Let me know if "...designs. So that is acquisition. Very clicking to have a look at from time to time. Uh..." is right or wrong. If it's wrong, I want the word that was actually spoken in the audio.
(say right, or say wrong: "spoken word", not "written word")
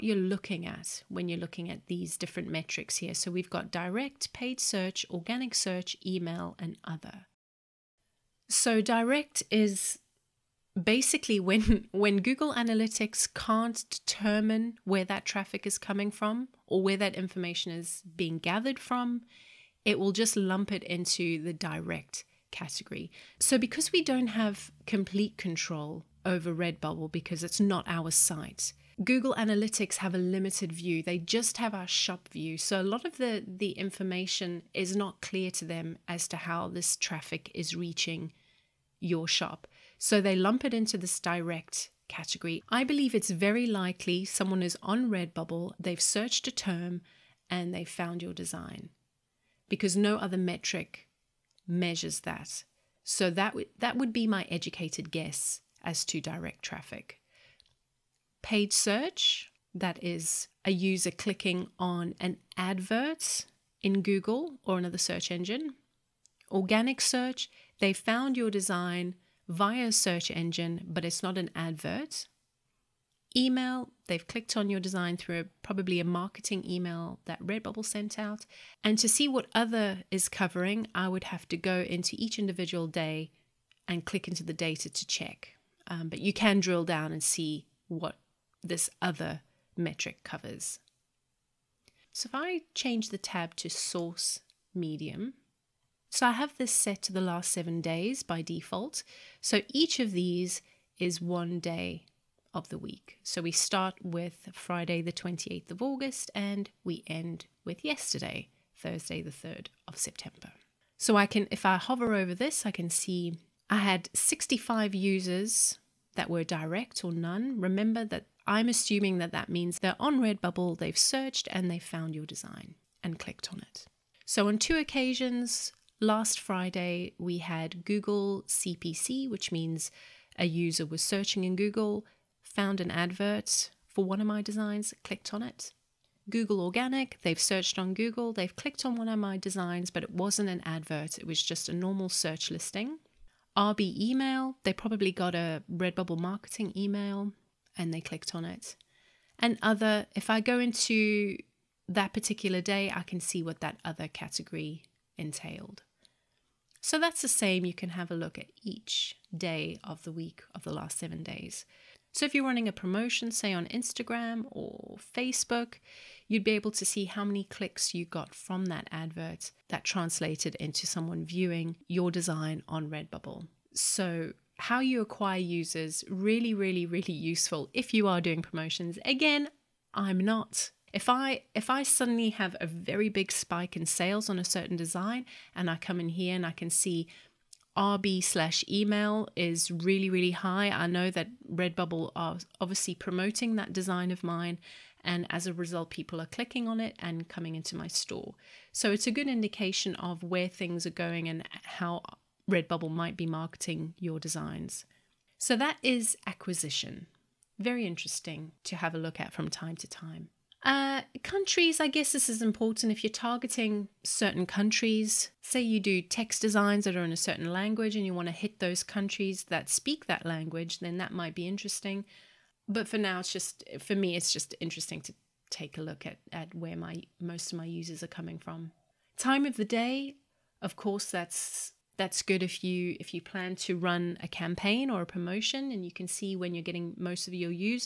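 wrong: "interesting", not "clicking".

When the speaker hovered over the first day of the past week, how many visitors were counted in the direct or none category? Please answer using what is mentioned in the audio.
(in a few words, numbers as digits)
65.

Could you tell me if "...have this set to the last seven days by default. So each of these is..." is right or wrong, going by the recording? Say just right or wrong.
right.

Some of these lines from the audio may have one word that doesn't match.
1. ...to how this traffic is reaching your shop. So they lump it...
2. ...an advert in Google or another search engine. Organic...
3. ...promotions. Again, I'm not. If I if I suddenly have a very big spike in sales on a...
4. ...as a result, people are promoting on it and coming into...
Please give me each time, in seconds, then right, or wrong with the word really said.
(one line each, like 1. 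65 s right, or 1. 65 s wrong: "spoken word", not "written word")
1. 36 s right
2. 62 s right
3. 178 s right
4. 195 s wrong: "clicking", not "promoting".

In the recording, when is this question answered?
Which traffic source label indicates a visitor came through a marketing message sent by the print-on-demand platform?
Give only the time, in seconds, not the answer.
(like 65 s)
143 s.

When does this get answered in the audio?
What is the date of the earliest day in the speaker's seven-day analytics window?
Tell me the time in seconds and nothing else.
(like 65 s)
105 s.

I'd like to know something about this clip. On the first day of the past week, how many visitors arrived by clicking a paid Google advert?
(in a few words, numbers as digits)
2.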